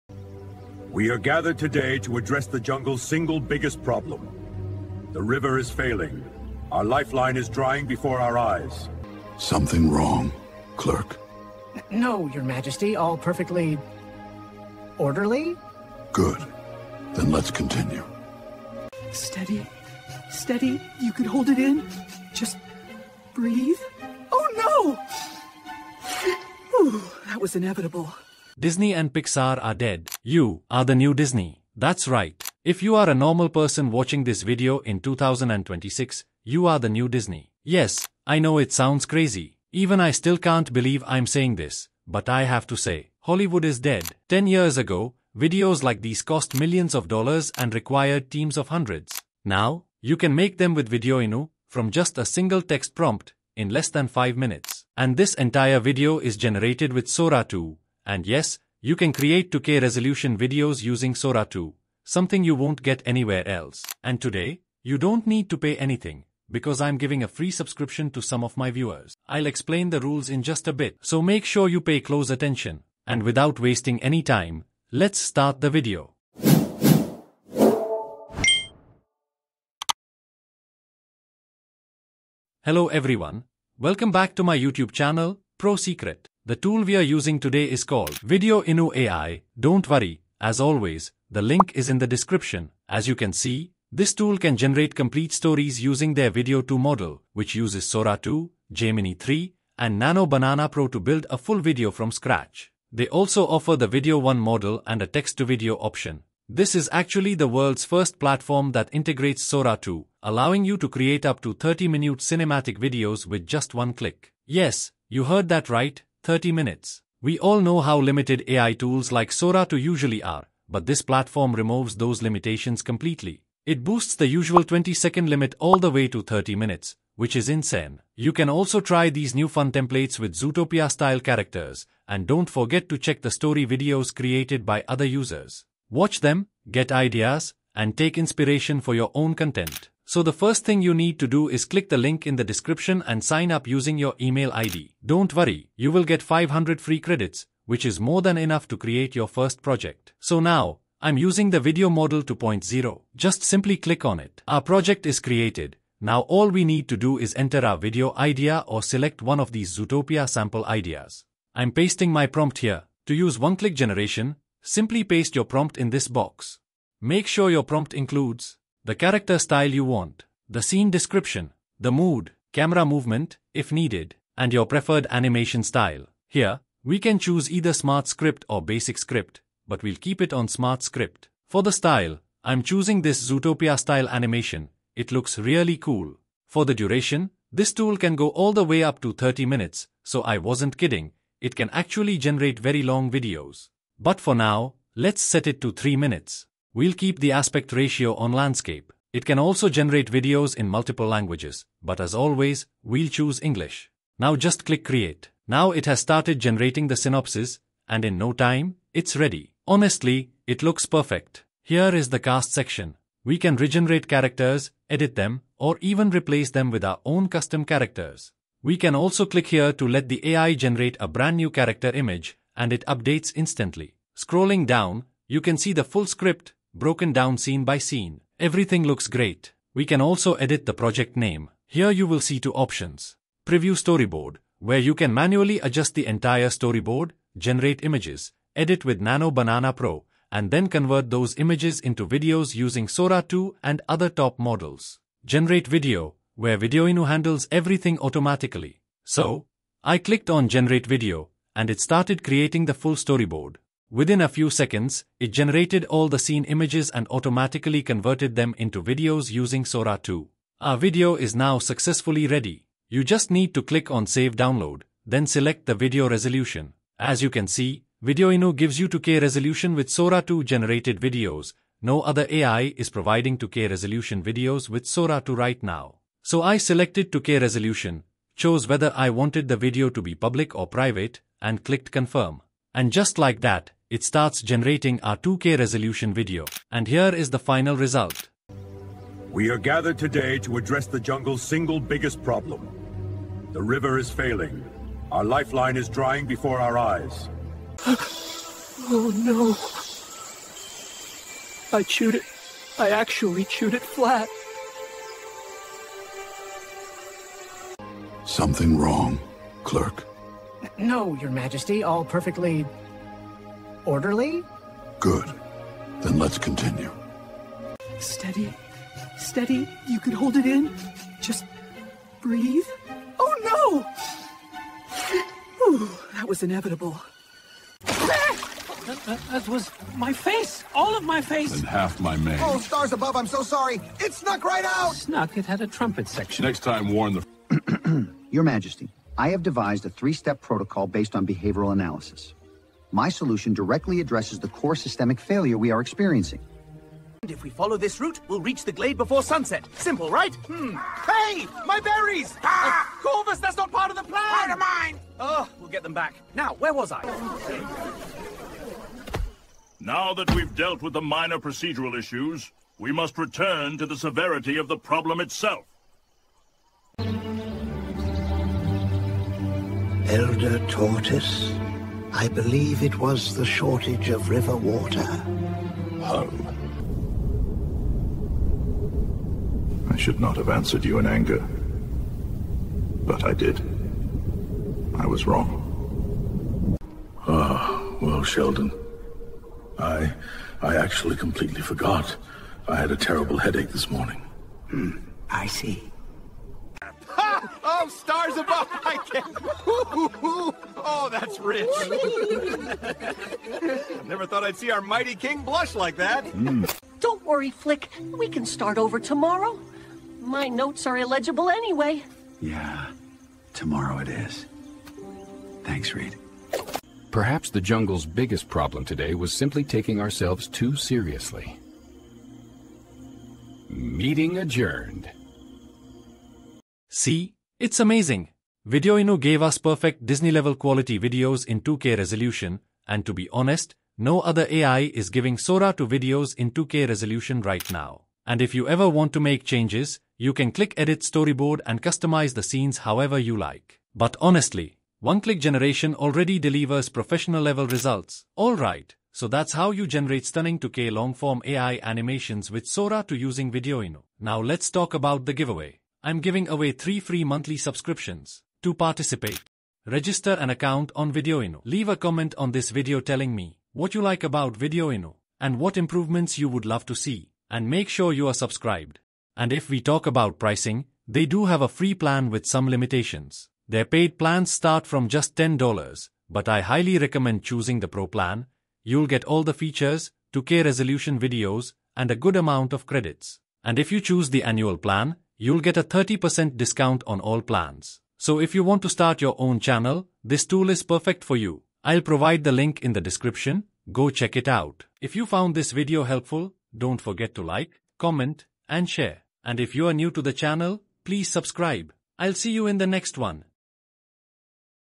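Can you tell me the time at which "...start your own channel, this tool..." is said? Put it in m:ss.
8:08.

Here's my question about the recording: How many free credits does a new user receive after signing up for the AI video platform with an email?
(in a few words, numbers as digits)
500.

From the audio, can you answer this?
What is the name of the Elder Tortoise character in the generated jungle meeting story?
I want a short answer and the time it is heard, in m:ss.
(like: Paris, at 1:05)
Sheldon, at 6:28.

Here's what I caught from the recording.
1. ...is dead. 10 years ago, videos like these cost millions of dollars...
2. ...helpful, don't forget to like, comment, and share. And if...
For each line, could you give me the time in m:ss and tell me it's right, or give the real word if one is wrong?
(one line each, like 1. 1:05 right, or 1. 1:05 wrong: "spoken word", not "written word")
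1. 0:43 right
2. 8:16 right.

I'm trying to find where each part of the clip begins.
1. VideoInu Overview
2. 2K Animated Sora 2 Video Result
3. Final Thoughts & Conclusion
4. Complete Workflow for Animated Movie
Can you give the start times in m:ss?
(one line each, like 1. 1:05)
1. 1:22
2. 4:48
3. 7:07
4. 2:30.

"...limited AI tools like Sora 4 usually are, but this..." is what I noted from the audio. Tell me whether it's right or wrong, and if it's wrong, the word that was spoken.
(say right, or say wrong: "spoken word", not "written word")
wrong: "2", not "4".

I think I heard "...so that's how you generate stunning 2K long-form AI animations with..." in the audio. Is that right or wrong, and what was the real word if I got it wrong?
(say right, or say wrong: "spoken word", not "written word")
right.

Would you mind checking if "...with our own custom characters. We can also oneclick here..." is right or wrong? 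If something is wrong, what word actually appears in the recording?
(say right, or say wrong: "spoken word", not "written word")
wrong: "click", not "oneclick".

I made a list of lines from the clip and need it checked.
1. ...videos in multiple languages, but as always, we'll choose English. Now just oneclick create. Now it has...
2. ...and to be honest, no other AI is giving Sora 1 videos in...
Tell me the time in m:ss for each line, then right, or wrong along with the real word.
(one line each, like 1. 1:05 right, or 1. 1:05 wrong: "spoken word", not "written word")
1. 3:20 wrong: "click", not "oneclick"
2. 7:12 wrong: "2", not "1".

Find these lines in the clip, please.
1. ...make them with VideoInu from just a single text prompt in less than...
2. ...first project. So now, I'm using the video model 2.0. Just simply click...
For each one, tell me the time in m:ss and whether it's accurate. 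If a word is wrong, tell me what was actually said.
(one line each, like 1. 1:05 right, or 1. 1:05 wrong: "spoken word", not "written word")
1. 0:50 right
2. 2:29 right.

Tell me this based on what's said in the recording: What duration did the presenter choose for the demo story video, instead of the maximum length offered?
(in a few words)
3 minutes.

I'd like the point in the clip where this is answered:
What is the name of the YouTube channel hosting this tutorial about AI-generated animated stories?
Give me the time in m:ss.
1:25.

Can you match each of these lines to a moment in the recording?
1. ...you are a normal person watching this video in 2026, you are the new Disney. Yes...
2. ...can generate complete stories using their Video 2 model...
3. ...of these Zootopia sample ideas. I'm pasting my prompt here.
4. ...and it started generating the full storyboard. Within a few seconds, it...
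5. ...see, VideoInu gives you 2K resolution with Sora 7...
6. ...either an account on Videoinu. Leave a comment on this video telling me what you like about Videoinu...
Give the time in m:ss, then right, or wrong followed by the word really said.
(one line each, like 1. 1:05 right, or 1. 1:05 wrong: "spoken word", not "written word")
1. 0:32 right
2. 1:34 right
3. 2:39 right
4. 4:11 wrong: "creating", not "generating"
5. 4:27 wrong: "2", not "7"
6. 7:39 wrong: "register", not "either".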